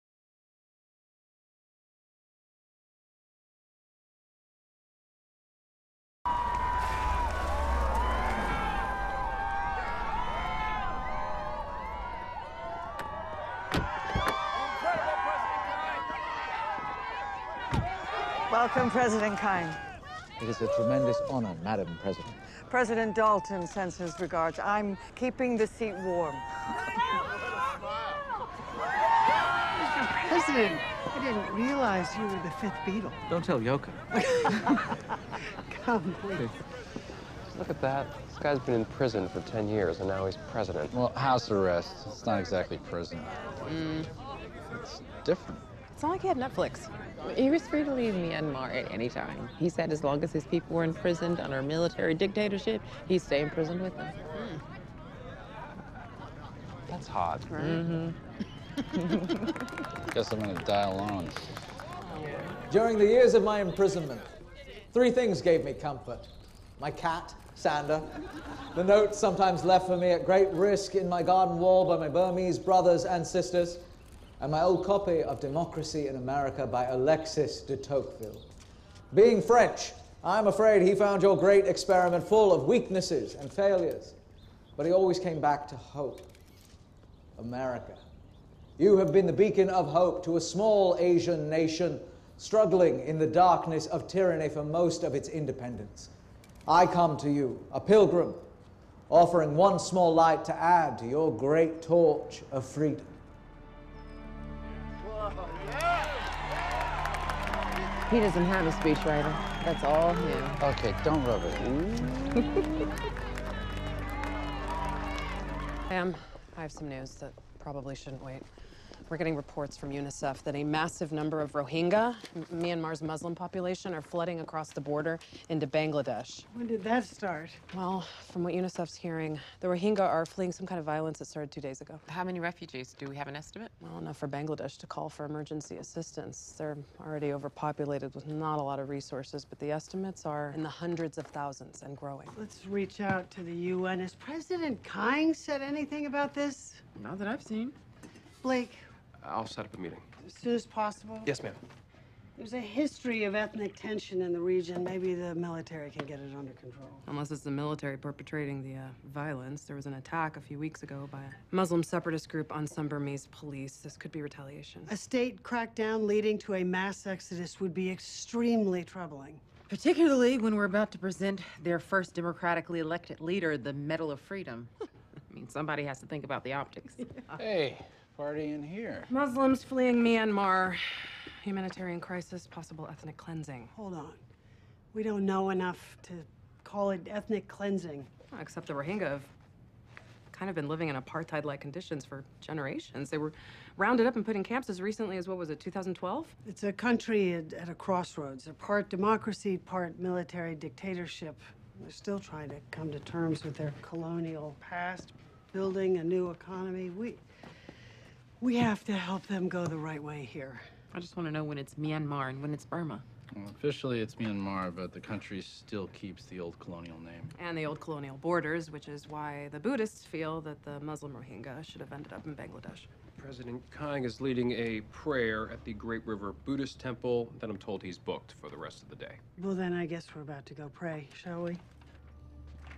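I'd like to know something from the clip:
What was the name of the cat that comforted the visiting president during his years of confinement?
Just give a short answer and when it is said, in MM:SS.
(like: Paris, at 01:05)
Sander, at 01:07.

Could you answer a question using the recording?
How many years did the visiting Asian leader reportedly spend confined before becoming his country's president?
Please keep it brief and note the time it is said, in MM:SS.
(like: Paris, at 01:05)
10, at 00:39.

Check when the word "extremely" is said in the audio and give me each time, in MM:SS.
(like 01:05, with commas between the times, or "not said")
02:47.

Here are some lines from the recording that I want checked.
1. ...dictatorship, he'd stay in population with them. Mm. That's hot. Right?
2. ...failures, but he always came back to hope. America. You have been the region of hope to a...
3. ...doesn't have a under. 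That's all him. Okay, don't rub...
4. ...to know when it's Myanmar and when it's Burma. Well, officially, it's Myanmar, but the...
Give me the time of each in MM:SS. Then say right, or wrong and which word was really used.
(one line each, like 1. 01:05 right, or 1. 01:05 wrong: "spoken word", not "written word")
1. 00:52 wrong: "prison", not "population"
2. 01:23 wrong: "beacon", not "region"
3. 01:48 wrong: "speechwriter", not "under"
4. 03:31 right.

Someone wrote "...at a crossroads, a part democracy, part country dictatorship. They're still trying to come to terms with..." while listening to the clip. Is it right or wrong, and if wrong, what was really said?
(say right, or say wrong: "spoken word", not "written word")
wrong: "military", not "country".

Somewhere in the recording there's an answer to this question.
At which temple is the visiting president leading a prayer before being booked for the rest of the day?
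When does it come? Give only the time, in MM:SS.
03:45.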